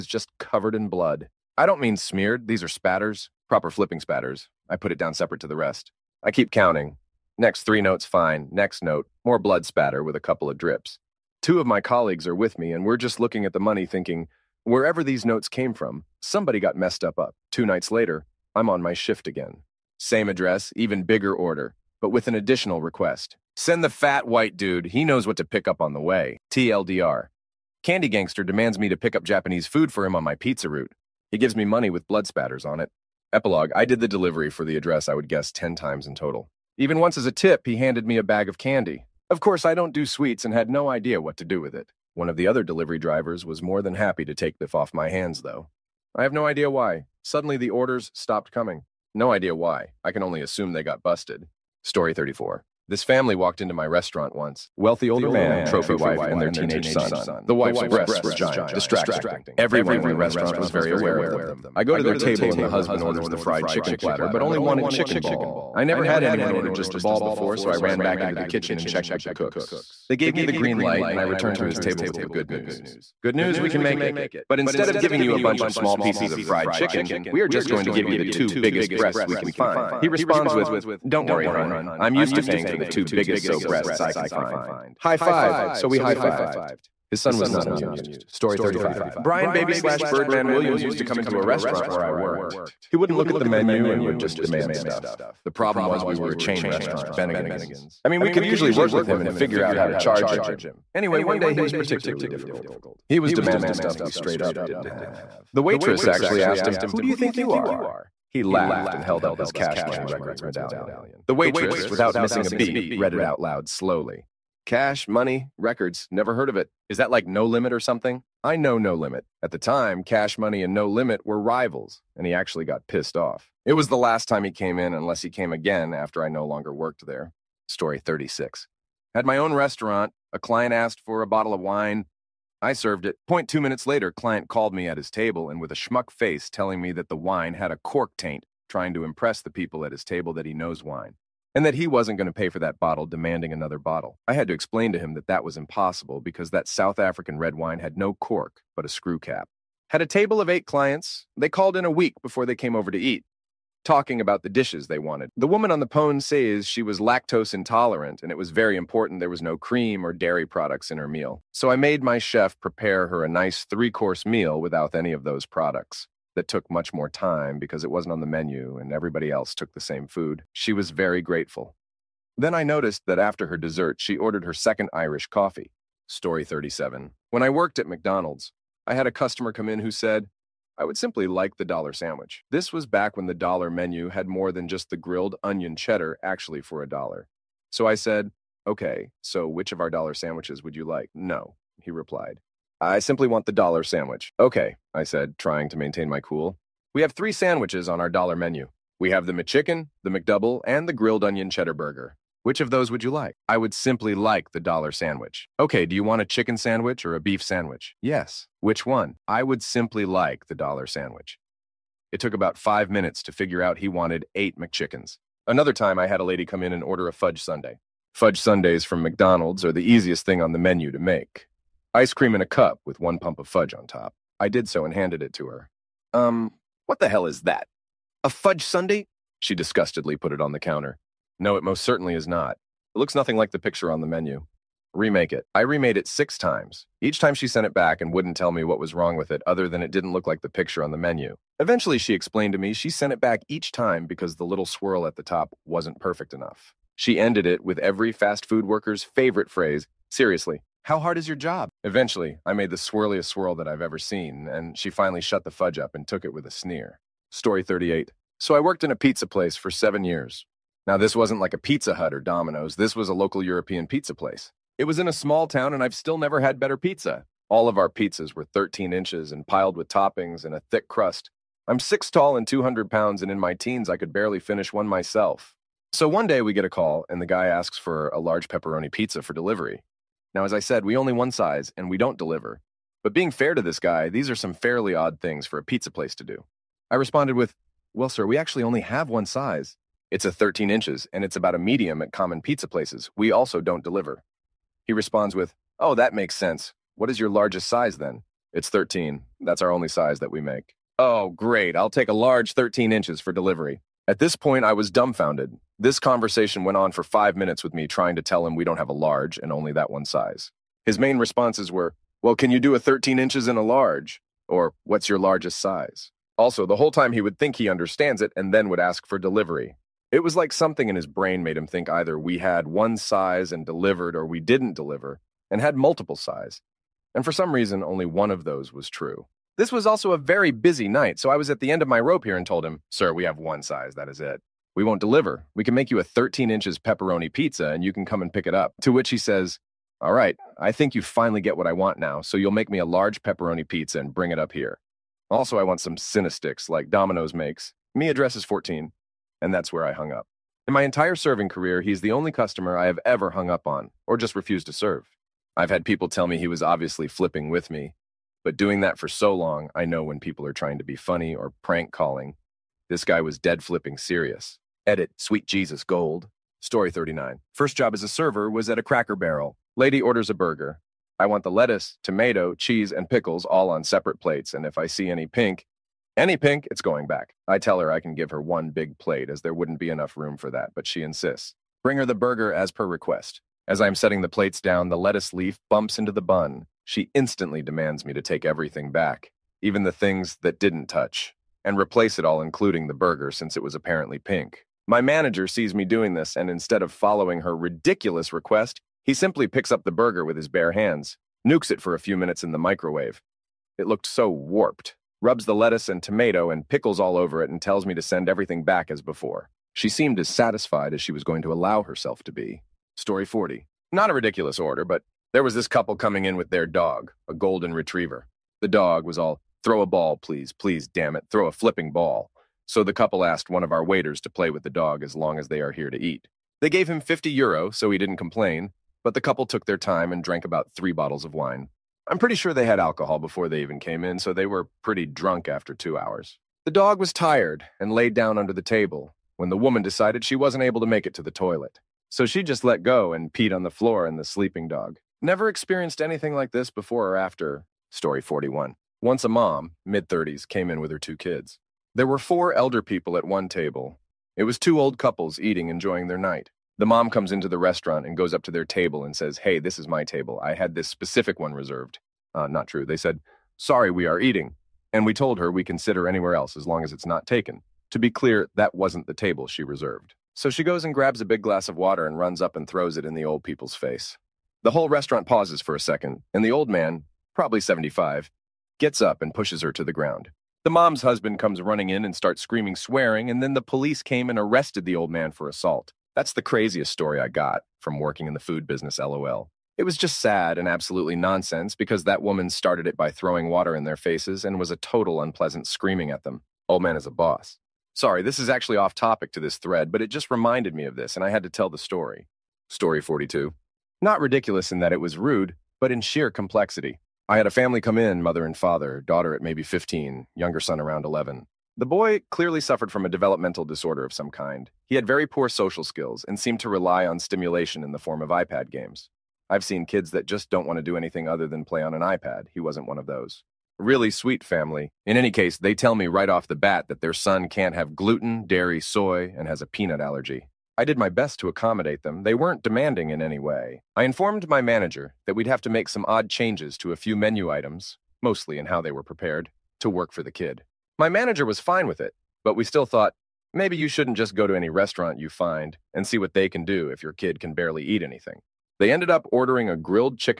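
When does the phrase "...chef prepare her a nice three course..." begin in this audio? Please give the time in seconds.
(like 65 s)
162 s.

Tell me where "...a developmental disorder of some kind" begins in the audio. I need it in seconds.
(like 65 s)
513 s.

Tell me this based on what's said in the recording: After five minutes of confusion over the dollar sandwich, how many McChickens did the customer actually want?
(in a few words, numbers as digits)
8.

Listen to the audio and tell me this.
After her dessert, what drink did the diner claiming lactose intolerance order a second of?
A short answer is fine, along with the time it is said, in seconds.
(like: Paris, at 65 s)
Irish coffee, at 174 s.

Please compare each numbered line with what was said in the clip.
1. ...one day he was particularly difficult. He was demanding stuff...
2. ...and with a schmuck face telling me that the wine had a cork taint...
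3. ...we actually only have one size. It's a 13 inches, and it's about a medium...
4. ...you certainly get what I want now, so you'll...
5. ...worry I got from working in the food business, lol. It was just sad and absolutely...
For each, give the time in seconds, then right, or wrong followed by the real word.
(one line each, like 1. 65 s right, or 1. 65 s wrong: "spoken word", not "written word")
1. 101 s right
2. 135 s right
3. 288 s right
4. 340 s wrong: "finally", not "certainly"
5. 486 s wrong: "story", not "worry".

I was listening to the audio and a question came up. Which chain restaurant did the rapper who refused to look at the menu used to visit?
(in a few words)
Bennigan's.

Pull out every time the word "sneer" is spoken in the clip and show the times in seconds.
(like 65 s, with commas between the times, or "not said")
256 s.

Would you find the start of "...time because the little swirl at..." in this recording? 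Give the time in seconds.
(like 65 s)
243 s.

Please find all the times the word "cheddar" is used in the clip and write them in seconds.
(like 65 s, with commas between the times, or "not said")
185 s, 201 s.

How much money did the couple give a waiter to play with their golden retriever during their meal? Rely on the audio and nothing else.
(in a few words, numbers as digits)
50 euros.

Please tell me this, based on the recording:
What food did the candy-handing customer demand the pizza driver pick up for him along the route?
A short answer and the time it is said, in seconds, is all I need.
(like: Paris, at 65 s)
Japanese food, at 29 s.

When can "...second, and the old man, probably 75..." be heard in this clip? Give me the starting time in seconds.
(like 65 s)
475 s.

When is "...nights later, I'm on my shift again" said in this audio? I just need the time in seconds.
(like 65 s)
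17 s.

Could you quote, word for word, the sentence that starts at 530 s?
I did my best to accommodate them.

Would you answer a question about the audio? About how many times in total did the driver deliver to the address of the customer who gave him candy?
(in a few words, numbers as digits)
10.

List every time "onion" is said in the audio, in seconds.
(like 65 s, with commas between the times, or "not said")
185 s, 201 s.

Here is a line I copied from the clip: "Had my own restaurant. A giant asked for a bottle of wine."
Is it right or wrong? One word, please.
wrong.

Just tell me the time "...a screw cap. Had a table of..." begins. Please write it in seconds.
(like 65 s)
148 s.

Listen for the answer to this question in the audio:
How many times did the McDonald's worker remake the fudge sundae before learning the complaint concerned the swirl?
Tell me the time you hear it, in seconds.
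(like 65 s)
236 s.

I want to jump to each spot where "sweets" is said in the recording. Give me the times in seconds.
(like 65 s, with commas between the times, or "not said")
40 s, 365 s, 524 s.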